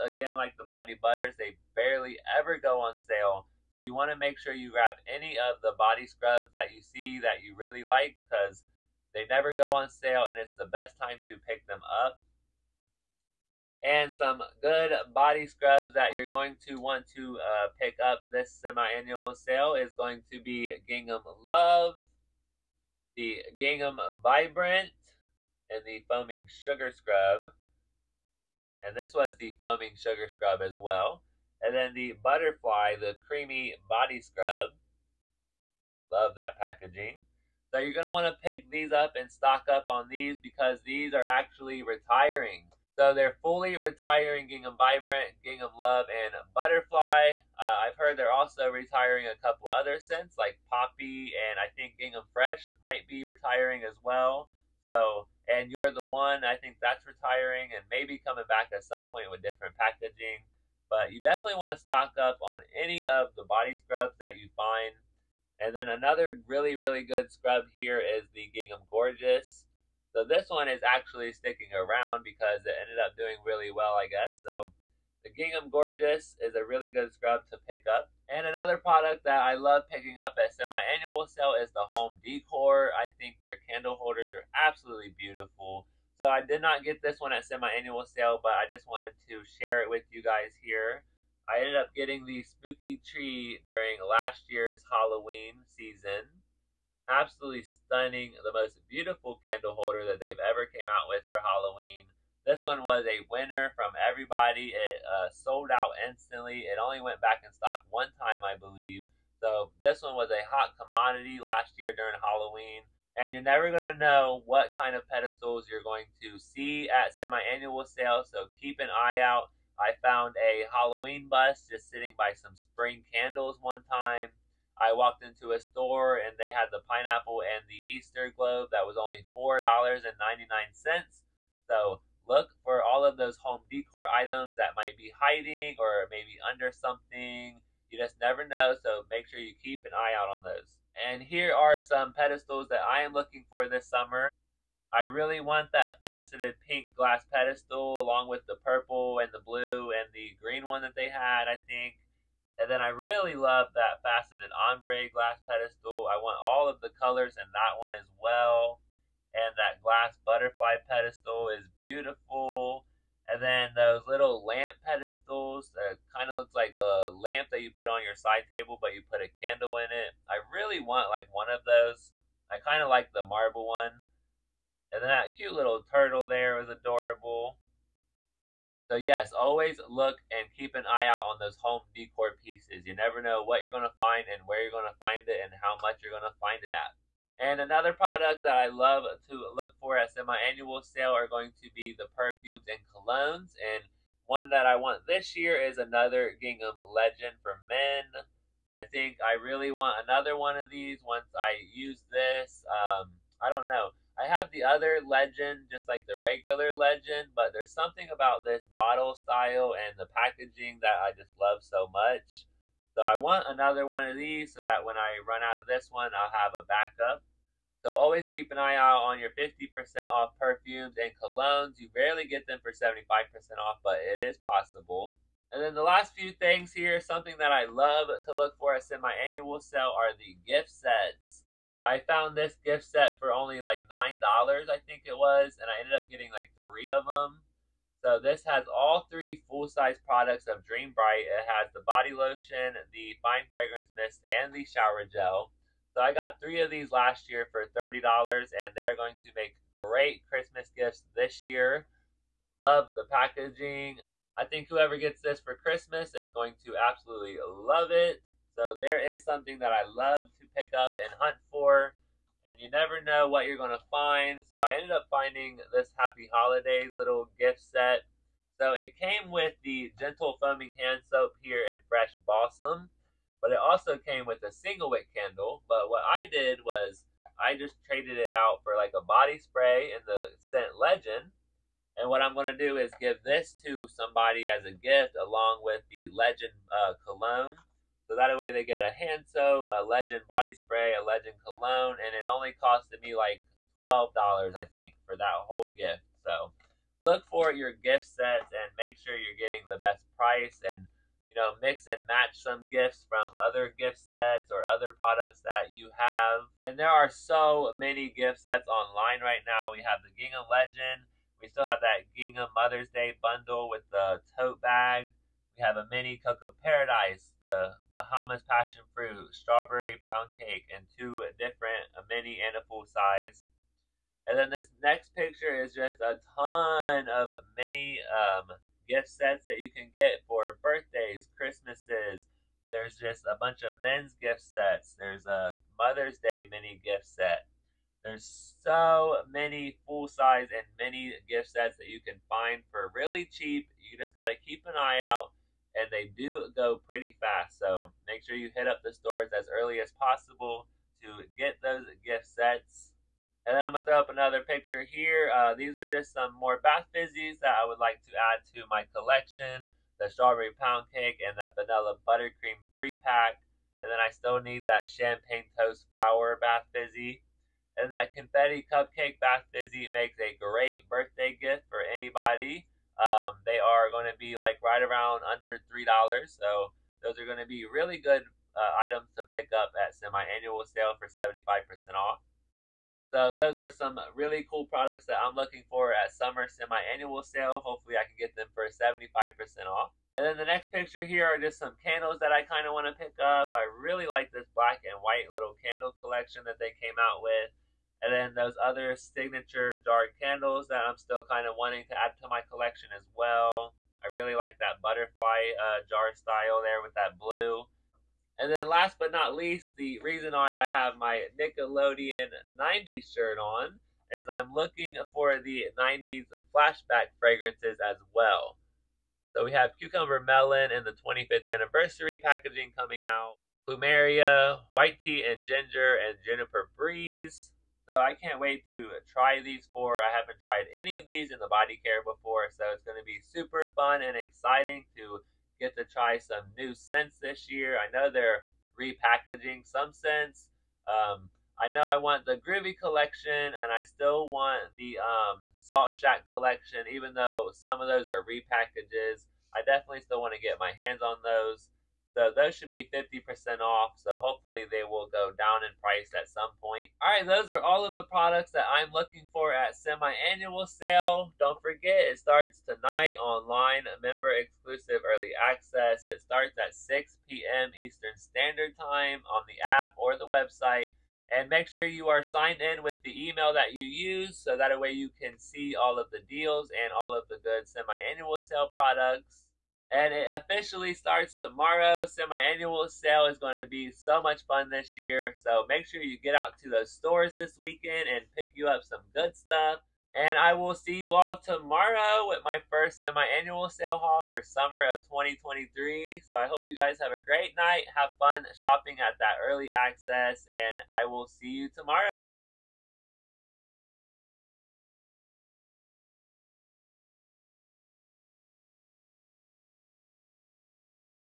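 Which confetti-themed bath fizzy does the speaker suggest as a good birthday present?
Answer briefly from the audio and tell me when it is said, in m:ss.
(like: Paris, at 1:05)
confetti cupcake, at 6:08.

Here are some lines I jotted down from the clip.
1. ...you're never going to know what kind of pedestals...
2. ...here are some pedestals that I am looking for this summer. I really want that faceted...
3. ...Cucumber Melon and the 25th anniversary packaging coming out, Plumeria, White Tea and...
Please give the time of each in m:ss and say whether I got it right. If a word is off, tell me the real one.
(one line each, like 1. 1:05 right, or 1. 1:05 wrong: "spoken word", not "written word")
1. 1:53 right
2. 2:21 right
3. 6:59 right.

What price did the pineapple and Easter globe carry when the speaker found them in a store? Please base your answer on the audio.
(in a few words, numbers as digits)
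$4.99.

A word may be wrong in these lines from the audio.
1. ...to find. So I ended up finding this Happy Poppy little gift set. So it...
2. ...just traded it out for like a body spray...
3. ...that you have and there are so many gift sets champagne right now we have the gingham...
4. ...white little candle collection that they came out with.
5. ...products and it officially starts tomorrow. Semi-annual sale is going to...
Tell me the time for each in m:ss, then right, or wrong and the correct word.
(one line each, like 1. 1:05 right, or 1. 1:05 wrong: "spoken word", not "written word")
1. 4:23 wrong: "Holidays", not "Poppy"
2. 4:37 right
3. 5:05 wrong: "online", not "champagne"
4. 6:35 right
5. 7:58 right.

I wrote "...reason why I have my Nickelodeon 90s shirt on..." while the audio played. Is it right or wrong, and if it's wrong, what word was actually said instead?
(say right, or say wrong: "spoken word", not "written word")
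right.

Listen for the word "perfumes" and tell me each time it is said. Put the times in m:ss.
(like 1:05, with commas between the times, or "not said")
3:12, 3:40.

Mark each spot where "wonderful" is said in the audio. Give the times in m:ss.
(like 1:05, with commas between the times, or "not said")
not said.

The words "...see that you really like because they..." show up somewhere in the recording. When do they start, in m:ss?
0:06.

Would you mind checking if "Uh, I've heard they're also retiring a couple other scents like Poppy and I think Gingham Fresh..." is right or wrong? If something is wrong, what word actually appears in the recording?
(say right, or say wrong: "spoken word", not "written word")
right.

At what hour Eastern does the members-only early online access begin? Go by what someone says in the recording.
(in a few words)
6 p.m.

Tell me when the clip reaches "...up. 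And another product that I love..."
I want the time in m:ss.
1:17.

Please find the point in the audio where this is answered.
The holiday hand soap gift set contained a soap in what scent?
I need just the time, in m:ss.
4:31.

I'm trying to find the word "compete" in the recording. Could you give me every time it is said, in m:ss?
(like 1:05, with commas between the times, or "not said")
not said.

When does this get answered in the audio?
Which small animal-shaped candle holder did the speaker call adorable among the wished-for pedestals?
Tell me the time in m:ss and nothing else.
2:55.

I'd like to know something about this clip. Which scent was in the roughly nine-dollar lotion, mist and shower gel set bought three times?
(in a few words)
Dream Bright.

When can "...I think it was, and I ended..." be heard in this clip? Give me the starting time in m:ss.
3:54.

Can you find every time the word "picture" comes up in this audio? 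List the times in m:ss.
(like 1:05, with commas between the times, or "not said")
5:25, 5:54, 6:30.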